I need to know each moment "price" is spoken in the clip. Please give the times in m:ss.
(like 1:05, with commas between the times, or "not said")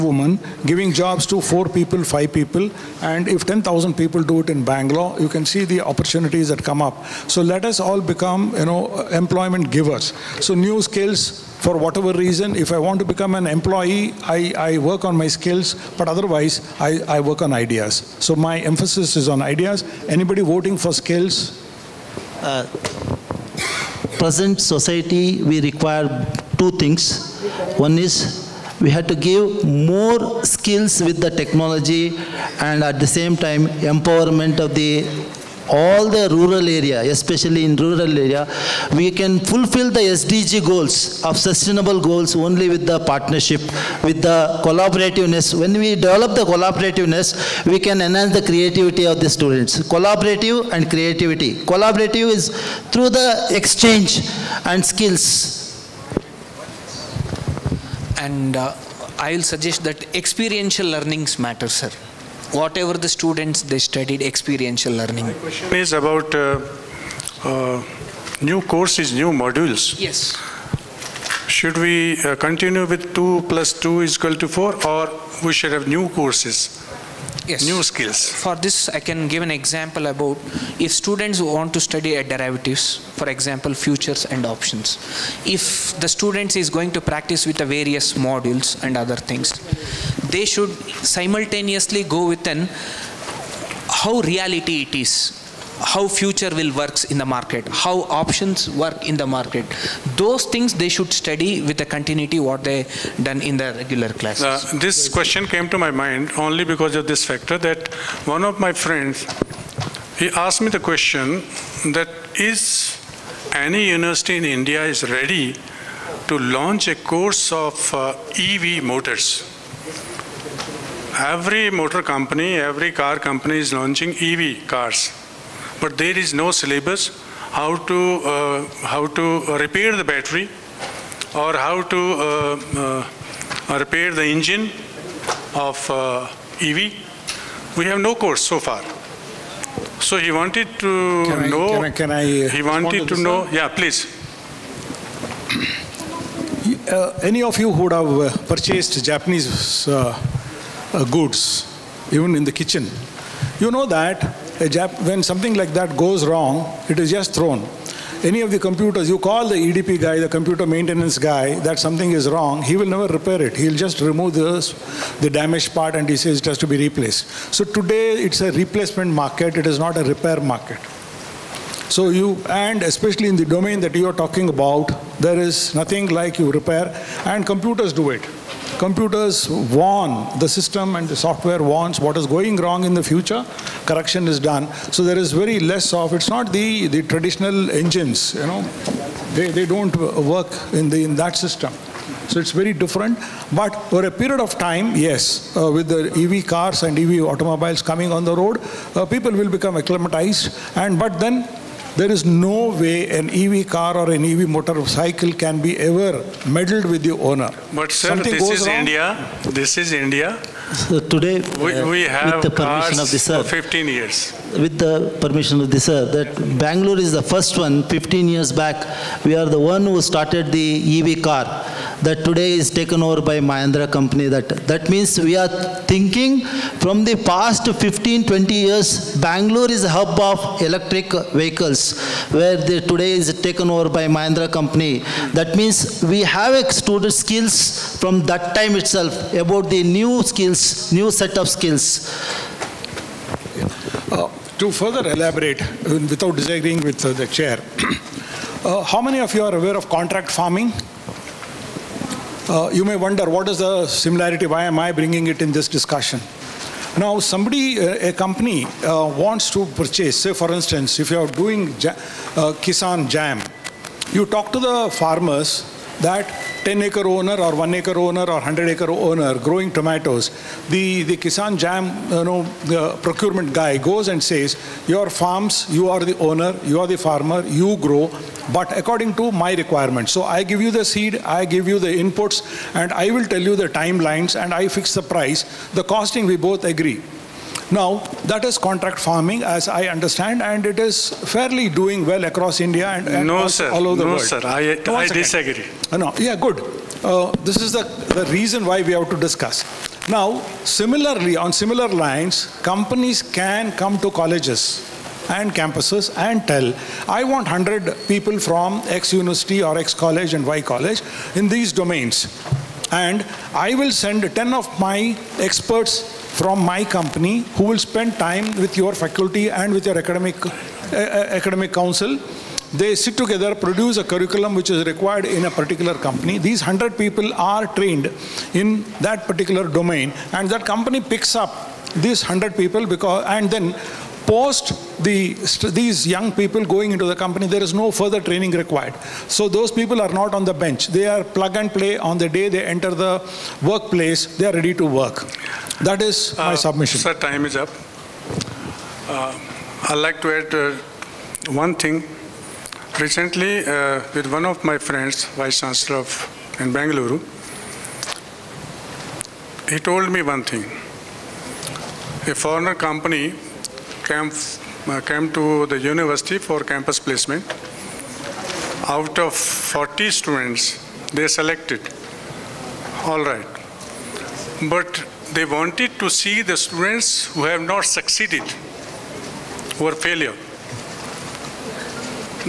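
4:45.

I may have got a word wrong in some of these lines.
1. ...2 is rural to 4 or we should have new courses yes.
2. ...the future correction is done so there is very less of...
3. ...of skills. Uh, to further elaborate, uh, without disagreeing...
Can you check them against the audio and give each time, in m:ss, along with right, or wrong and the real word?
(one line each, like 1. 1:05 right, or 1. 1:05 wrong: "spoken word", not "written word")
1. 1:13 wrong: "equal", not "rural"
2. 3:02 right
3. 4:01 right.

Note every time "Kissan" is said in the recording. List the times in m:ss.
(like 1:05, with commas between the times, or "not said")
4:22, 4:31.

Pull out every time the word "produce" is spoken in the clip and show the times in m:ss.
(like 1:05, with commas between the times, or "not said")
5:23.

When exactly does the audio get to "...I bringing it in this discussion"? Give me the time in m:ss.
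4:14.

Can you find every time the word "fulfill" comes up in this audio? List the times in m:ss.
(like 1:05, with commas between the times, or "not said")
0:39.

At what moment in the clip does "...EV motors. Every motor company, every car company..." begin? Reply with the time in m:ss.
1:58.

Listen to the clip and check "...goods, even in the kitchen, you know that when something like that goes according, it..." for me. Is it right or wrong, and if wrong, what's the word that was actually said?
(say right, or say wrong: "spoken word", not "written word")
wrong: "wrong", not "according".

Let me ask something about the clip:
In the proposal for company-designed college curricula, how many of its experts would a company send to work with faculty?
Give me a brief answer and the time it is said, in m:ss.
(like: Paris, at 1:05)
10, at 5:14.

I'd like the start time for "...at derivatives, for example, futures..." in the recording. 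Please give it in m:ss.
1:22.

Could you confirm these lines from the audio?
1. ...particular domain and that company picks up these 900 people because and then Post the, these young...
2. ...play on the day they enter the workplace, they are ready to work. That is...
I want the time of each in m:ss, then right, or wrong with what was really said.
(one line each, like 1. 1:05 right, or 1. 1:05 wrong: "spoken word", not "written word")
1. 5:29 wrong: "100", not "900"
2. 5:41 right.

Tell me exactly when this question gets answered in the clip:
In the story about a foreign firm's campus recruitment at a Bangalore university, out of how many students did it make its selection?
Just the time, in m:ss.
6:08.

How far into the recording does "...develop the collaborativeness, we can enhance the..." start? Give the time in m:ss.
0:45.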